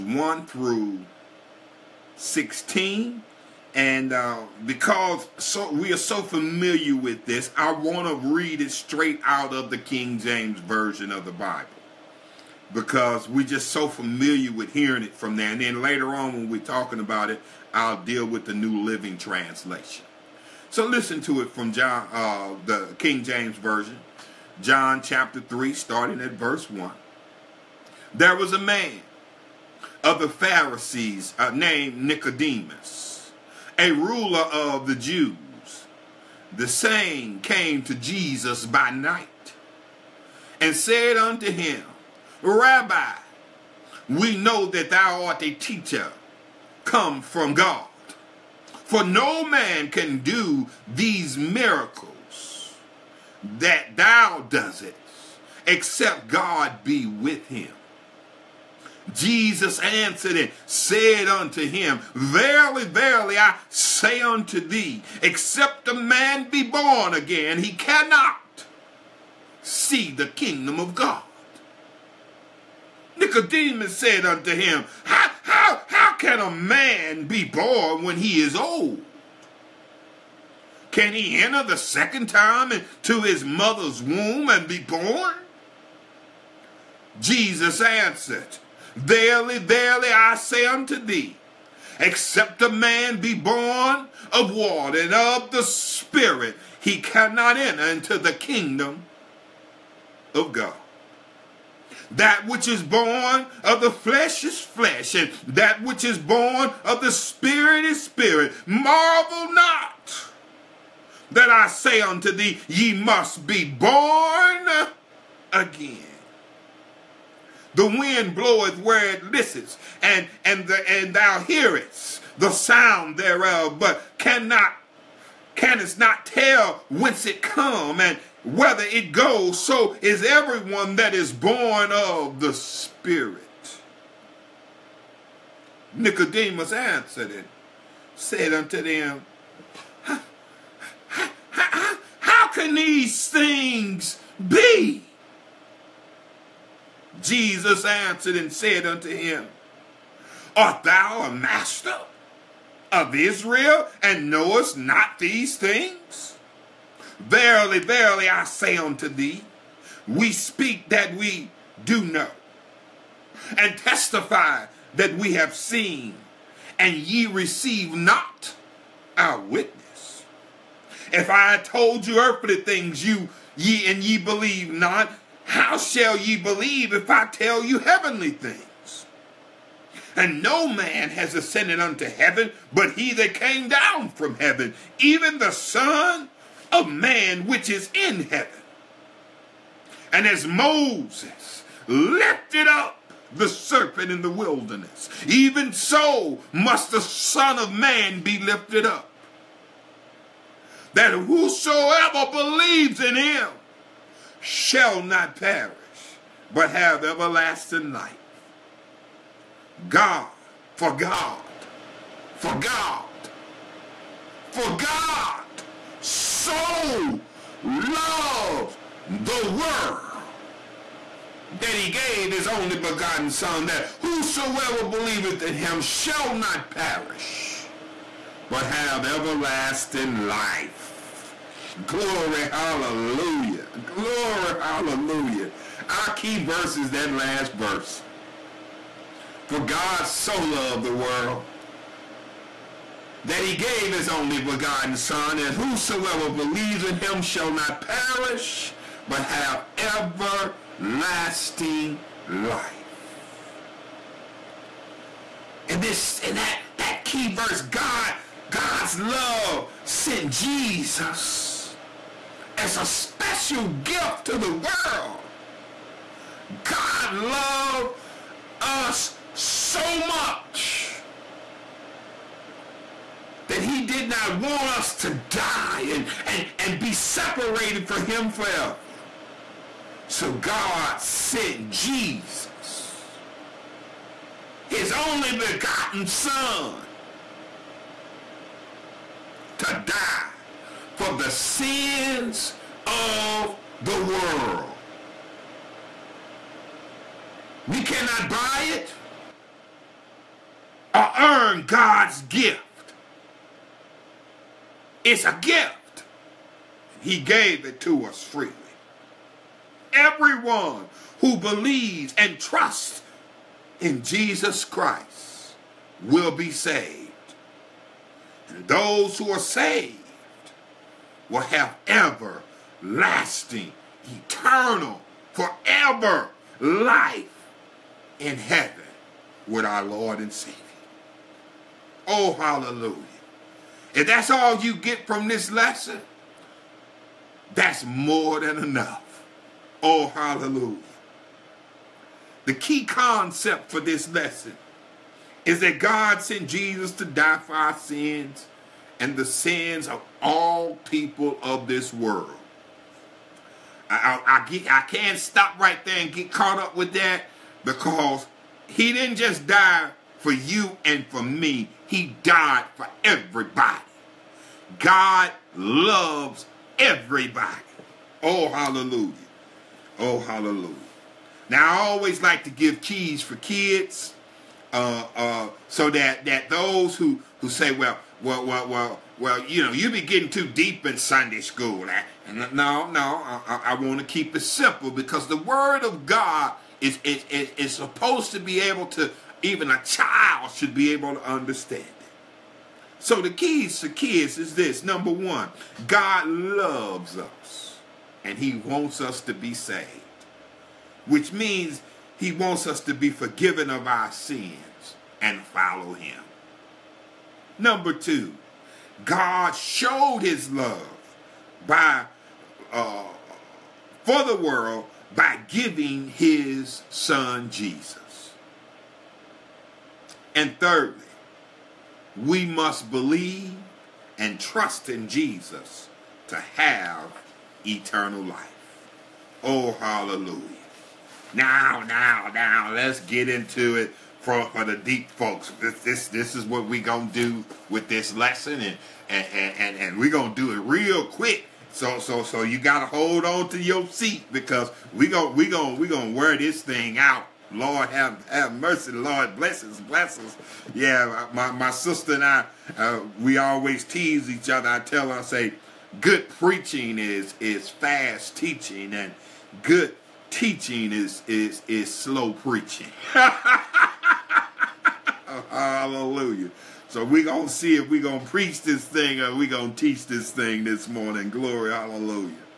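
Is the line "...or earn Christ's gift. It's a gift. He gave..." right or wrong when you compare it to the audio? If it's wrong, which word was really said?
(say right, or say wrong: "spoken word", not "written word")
wrong: "God", not "Christ".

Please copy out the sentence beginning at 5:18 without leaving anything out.
And those who are saved will have everlasting, eternal, forever life in heaven with our Lord and Savior.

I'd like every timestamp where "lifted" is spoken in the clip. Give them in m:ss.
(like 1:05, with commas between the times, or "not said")
3:11, 3:18.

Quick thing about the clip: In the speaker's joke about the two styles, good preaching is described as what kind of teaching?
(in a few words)
fast teaching.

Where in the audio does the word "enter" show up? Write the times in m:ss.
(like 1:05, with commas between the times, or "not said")
1:21, 1:37.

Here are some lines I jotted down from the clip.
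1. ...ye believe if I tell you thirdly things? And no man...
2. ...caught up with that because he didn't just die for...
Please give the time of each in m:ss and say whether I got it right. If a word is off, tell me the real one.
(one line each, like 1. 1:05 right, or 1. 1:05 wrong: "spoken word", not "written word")
1. 2:56 wrong: "heavenly", not "thirdly"
2. 5:56 right.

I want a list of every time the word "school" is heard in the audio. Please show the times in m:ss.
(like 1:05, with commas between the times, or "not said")
6:21.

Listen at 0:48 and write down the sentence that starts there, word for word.
For no man can do these miracles that thou doest, except God be with him.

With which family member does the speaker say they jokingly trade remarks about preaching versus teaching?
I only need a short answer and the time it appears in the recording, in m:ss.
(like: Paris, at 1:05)
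sister, at 7:31.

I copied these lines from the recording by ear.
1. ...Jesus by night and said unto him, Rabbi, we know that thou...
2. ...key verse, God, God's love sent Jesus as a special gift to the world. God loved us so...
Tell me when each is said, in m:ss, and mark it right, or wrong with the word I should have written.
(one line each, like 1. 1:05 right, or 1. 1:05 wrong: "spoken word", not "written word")
1. 0:37 right
2. 4:17 right.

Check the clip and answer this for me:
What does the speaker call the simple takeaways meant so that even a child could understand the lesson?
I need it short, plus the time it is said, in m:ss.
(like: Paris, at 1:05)
keys for kids, at 6:12.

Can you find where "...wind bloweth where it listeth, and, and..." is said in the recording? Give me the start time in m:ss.
1:57.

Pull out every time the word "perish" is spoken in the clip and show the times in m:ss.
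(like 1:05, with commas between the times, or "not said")
3:25, 3:46, 4:07.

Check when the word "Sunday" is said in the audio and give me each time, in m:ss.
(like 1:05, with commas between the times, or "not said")
6:20.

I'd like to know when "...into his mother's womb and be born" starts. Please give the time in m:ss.
1:22.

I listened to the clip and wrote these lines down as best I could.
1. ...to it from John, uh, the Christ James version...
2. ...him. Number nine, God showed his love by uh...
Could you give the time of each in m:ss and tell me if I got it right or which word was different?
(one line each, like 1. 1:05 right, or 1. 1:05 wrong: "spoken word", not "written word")
1. 0:21 wrong: "King", not "Christ"
2. 6:45 wrong: "two", not "nine".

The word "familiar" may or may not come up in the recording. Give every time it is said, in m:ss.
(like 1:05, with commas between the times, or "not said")
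0:06, 0:13.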